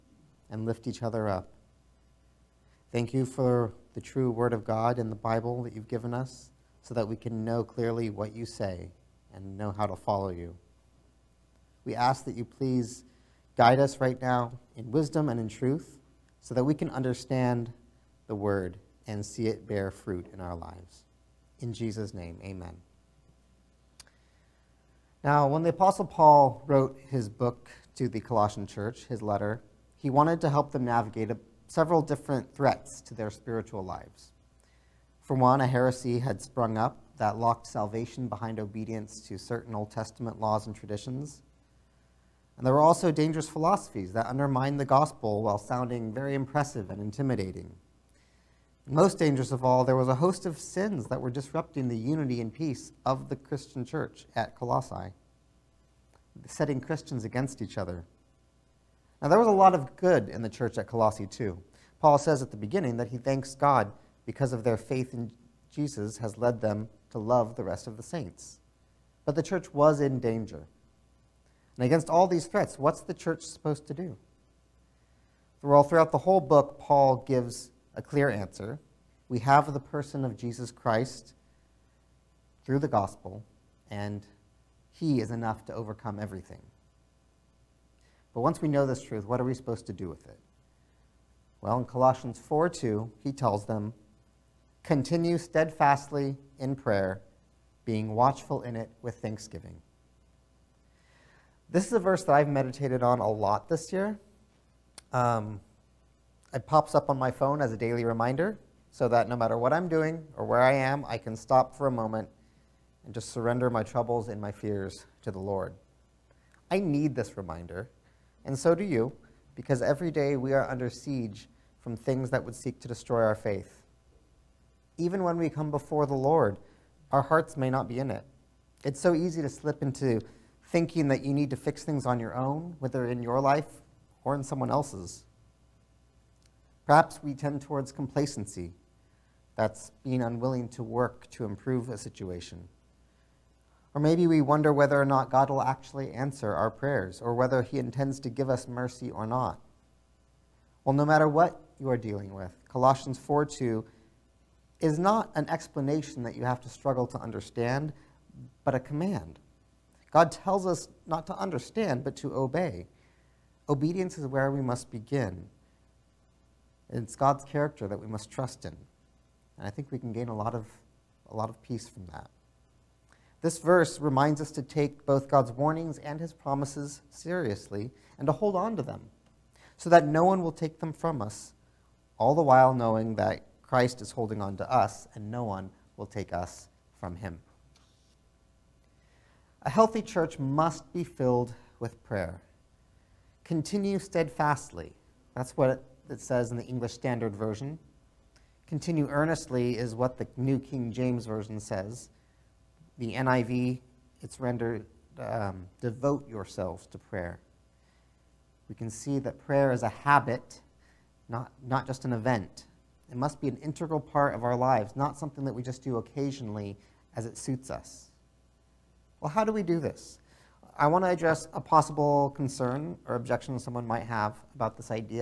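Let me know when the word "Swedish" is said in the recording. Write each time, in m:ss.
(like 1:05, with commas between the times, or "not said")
not said.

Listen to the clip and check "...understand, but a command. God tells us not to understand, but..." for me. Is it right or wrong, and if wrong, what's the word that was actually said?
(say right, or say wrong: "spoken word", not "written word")
right.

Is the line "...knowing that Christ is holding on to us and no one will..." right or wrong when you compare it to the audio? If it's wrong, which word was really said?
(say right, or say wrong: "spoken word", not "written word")
right.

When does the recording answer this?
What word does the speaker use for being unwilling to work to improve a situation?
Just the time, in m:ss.
2:17.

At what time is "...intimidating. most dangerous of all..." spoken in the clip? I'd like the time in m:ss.
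0:47.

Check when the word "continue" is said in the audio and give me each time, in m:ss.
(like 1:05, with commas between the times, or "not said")
1:34, 3:13, 3:18.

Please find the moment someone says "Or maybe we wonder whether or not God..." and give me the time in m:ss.
2:23.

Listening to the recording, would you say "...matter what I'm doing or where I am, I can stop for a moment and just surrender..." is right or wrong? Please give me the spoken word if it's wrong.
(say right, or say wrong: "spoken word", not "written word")
right.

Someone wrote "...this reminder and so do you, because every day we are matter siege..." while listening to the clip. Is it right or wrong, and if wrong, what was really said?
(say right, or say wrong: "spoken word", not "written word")
wrong: "under", not "matter".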